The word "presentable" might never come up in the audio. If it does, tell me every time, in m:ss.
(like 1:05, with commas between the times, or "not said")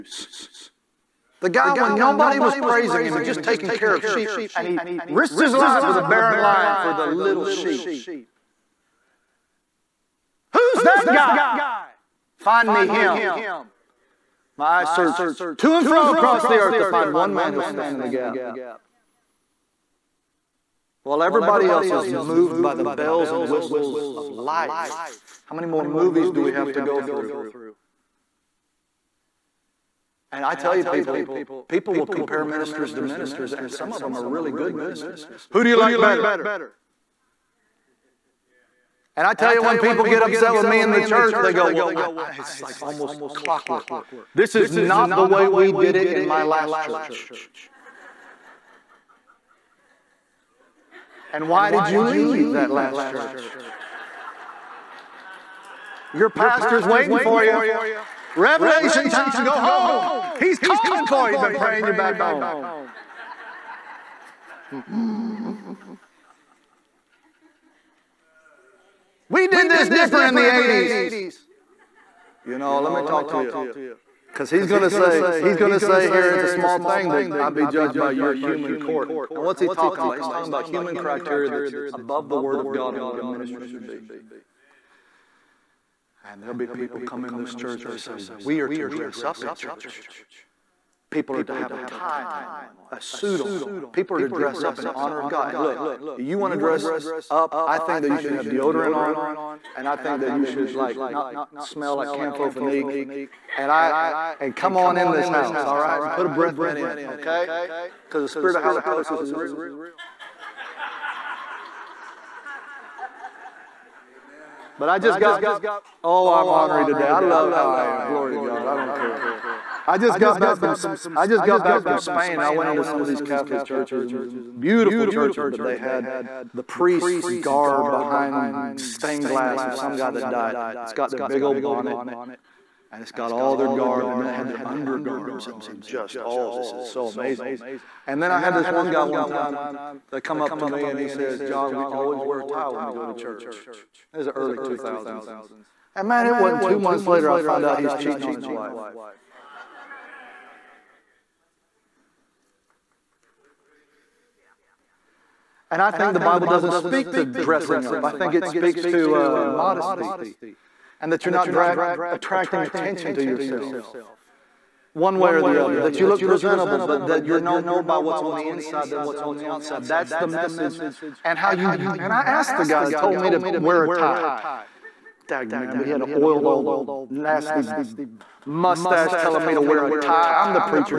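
2:46.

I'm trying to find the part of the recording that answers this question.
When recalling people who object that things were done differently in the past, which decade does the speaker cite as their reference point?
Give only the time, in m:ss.
1:10.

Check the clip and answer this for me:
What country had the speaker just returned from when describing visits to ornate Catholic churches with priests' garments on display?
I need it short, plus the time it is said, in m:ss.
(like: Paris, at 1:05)
Spain, at 2:01.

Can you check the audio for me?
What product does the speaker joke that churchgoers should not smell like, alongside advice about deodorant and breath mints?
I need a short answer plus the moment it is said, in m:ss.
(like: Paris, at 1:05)
Campho-Phenique, at 1:42.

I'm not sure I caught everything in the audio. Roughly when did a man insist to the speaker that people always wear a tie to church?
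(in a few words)
early 2000s.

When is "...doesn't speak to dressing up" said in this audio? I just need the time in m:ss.
2:36.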